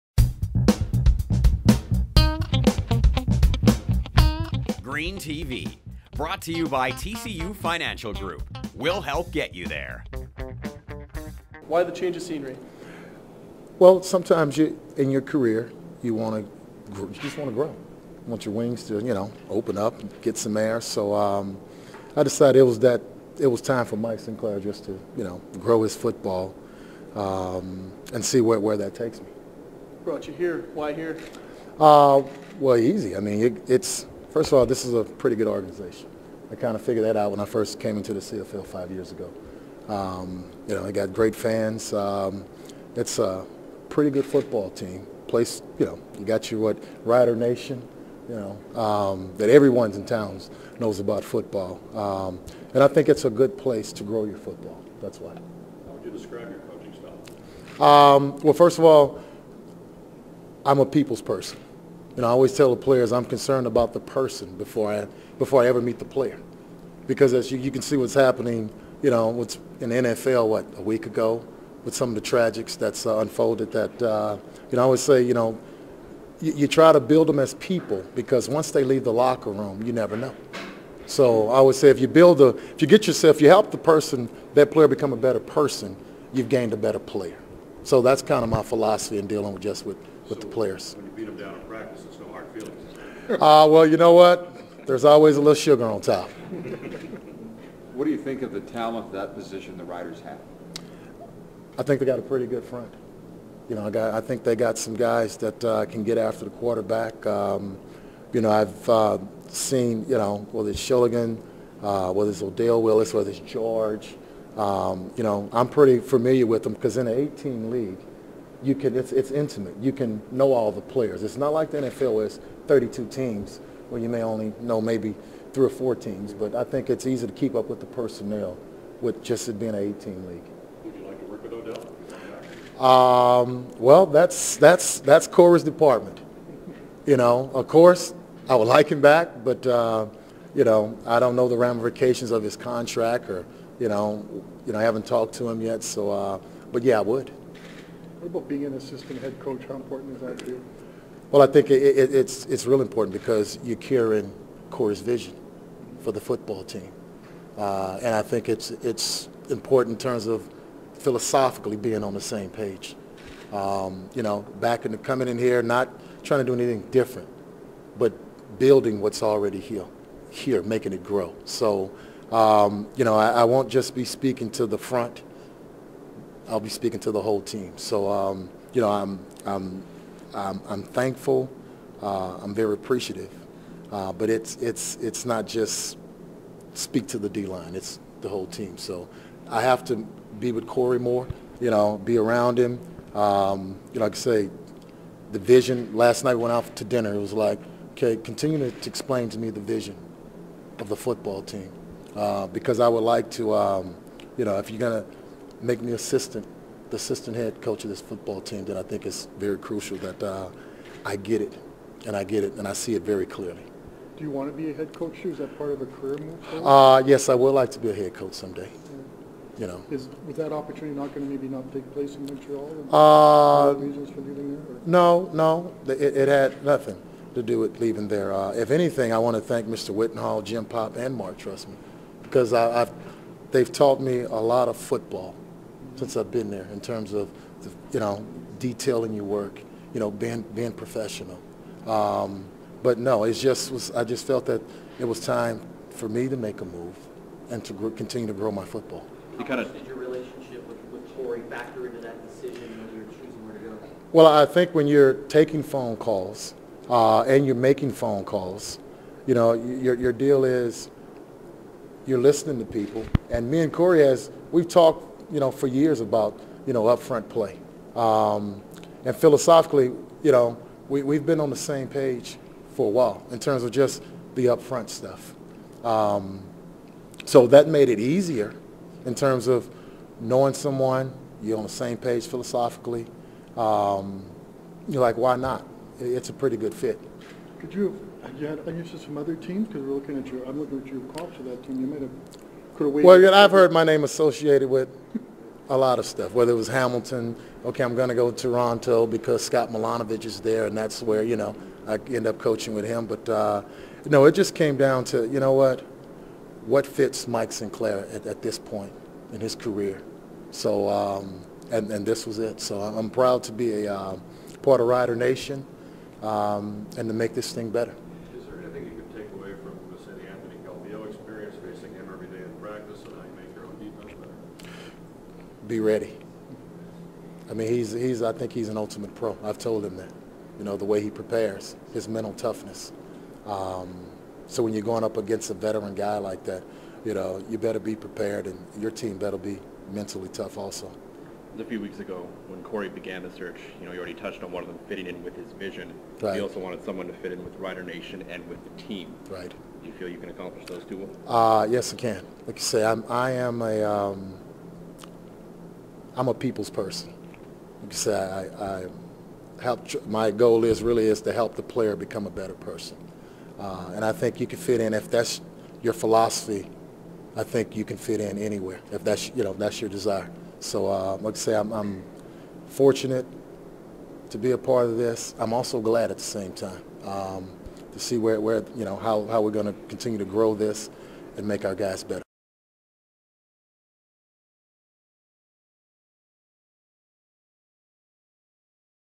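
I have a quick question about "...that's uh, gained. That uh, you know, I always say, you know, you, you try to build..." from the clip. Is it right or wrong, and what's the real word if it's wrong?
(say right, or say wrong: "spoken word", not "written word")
wrong: "unfolded", not "gained".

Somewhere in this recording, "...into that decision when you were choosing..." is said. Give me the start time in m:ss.
4:11.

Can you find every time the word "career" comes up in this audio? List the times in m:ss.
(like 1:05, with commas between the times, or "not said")
0:15, 3:35, 5:09.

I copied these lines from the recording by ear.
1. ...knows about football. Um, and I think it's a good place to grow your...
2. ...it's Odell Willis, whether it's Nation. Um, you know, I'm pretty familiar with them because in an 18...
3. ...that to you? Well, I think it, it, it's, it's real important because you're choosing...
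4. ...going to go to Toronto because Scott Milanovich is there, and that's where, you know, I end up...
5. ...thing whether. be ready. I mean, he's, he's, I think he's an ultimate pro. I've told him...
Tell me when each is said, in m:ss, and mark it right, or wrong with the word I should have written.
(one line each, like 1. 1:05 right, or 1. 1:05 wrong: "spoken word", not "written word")
1. 0:50 right
2. 1:52 wrong: "George", not "Nation"
3. 2:30 wrong: "carrying", not "choosing"
4. 4:57 right
5. 5:17 wrong: "better", not "whether".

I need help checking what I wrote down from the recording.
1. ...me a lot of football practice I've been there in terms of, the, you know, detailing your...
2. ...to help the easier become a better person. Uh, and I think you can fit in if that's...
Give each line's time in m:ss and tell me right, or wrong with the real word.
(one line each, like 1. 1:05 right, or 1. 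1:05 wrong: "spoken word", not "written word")
1. 3:53 wrong: "since", not "practice"
2. 6:01 wrong: "player", not "easier".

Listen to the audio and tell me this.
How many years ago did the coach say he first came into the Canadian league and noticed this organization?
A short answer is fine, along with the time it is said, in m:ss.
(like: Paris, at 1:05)
5, at 0:38.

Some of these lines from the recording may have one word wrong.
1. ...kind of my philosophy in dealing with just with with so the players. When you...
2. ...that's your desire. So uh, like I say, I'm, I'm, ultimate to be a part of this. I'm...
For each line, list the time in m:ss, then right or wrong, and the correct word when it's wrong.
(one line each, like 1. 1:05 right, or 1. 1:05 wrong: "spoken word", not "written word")
1. 1:28 right
2. 6:09 wrong: "fortunate", not "ultimate".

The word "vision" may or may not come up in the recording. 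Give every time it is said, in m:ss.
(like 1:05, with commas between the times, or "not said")
2:35, 3:15, 3:19, 5:45.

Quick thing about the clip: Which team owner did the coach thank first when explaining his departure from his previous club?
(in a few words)
Mr. Wetenhall.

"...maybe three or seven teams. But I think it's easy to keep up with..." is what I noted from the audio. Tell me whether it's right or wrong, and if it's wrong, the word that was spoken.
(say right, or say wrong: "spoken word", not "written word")
wrong: "four", not "seven".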